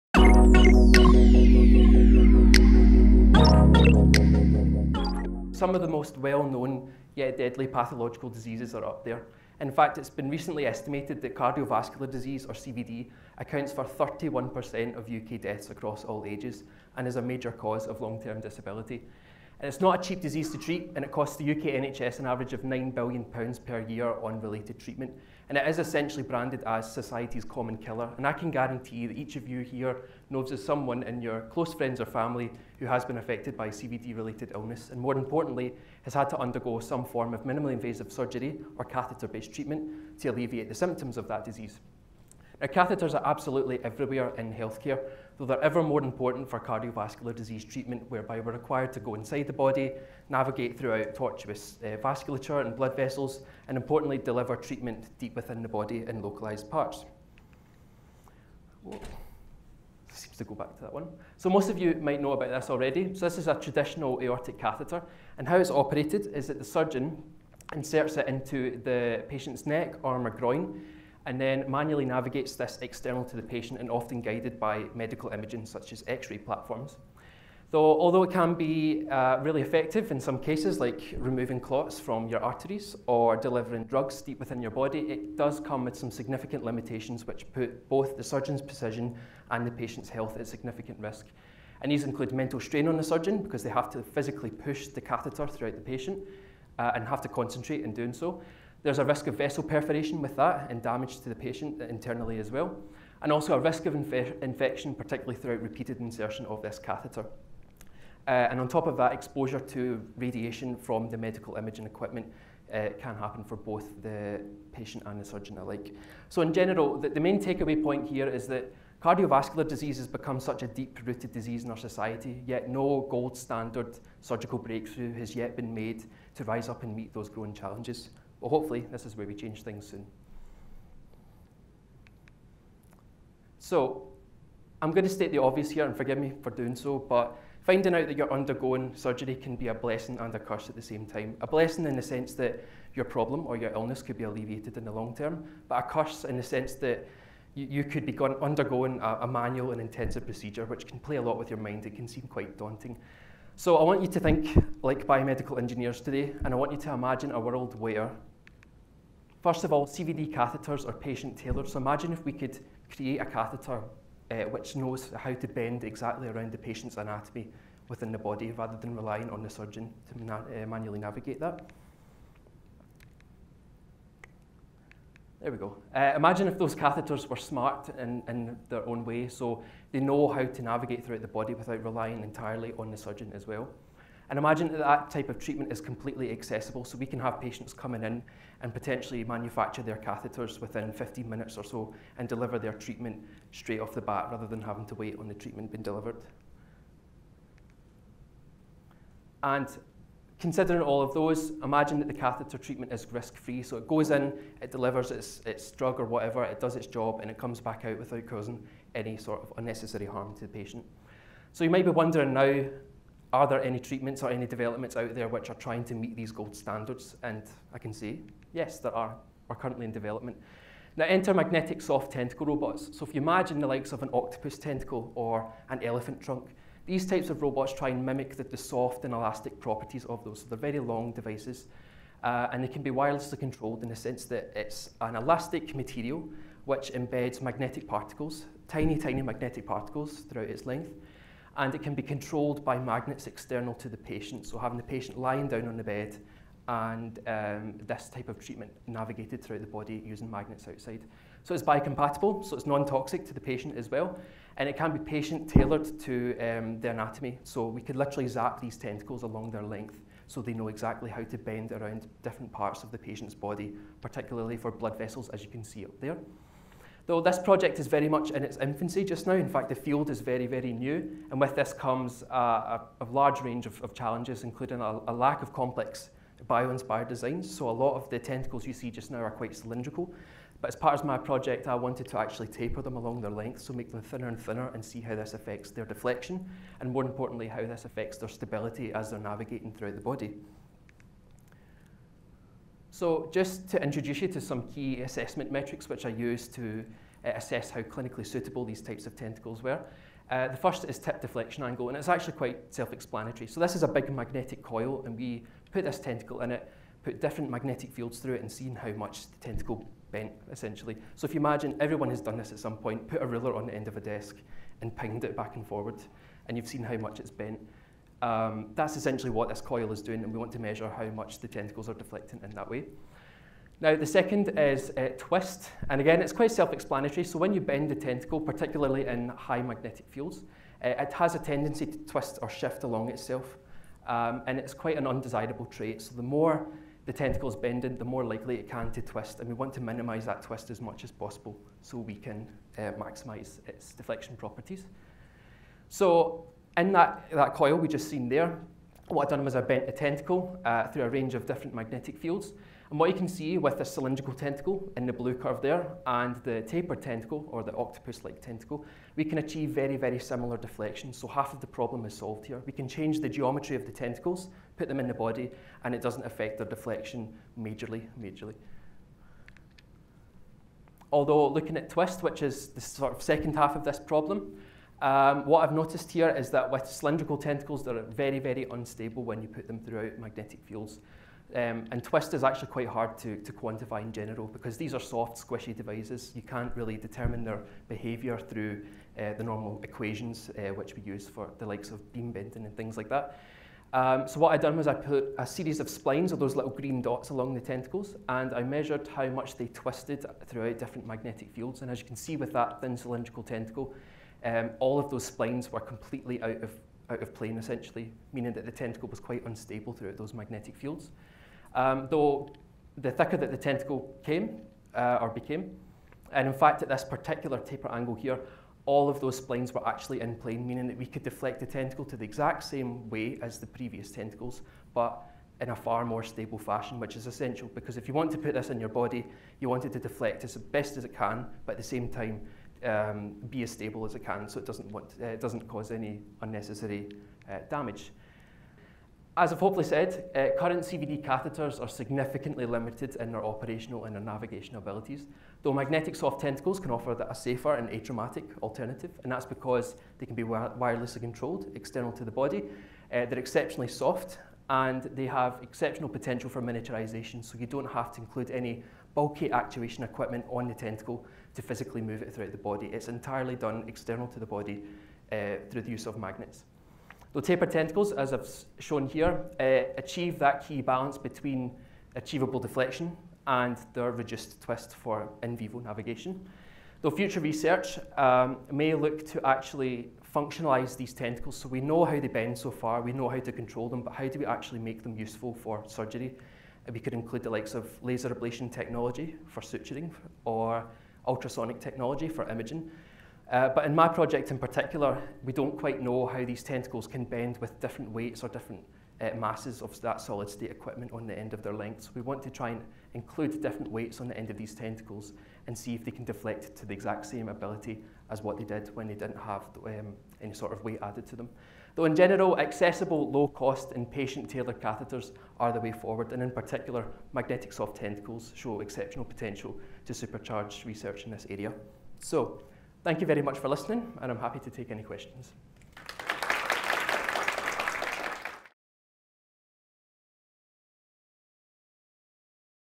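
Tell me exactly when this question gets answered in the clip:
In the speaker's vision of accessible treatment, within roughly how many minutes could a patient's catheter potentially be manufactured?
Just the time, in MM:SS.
03:10.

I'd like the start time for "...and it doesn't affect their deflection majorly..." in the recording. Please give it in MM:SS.
06:05.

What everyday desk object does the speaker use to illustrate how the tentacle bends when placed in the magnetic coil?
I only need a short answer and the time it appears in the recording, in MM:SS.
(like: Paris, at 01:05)
A ruler, at 05:13.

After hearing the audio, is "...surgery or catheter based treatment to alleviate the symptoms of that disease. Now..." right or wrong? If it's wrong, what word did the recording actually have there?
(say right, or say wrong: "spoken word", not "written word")
right.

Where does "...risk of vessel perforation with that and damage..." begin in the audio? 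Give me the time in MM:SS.
01:39.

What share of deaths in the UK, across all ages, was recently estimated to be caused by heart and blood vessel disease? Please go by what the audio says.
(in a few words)
31%.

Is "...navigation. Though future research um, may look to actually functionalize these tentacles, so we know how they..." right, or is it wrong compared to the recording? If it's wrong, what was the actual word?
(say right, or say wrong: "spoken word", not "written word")
right.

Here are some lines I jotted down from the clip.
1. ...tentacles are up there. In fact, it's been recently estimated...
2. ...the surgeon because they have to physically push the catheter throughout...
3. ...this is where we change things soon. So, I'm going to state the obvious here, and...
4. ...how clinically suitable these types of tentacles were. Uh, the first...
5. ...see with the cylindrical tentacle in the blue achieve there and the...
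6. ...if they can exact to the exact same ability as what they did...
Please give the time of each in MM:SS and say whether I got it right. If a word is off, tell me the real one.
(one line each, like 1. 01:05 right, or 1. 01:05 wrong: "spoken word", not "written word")
1. 00:08 wrong: "diseases", not "tentacles"
2. 01:32 right
3. 02:08 right
4. 04:57 right
5. 05:53 wrong: "curve", not "achieve"
6. 08:25 wrong: "deflect", not "exact".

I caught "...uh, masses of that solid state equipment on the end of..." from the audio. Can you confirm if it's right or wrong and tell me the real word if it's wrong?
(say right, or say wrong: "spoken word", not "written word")
right.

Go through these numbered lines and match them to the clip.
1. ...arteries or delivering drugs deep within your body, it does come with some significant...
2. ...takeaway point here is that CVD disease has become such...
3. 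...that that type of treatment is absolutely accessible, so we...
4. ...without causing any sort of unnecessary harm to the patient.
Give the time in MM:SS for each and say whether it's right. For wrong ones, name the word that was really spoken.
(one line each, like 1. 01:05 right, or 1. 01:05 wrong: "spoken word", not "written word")
1. 01:22 right
2. 01:57 wrong: "Cardiovascular", not "CVD"
3. 03:04 wrong: "completely", not "absolutely"
4. 03:27 right.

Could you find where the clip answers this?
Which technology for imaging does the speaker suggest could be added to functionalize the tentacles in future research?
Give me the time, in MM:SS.
08:11.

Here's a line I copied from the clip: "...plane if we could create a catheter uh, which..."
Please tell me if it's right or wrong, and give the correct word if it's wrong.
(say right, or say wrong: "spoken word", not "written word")
wrong: "imagine", not "plane".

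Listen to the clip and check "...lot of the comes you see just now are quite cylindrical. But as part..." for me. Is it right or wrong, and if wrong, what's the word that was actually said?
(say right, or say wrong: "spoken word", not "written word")
wrong: "tentacles", not "comes".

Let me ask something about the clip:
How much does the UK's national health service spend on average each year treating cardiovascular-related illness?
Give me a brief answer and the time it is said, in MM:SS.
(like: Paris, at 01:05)
£9 billion, at 00:22.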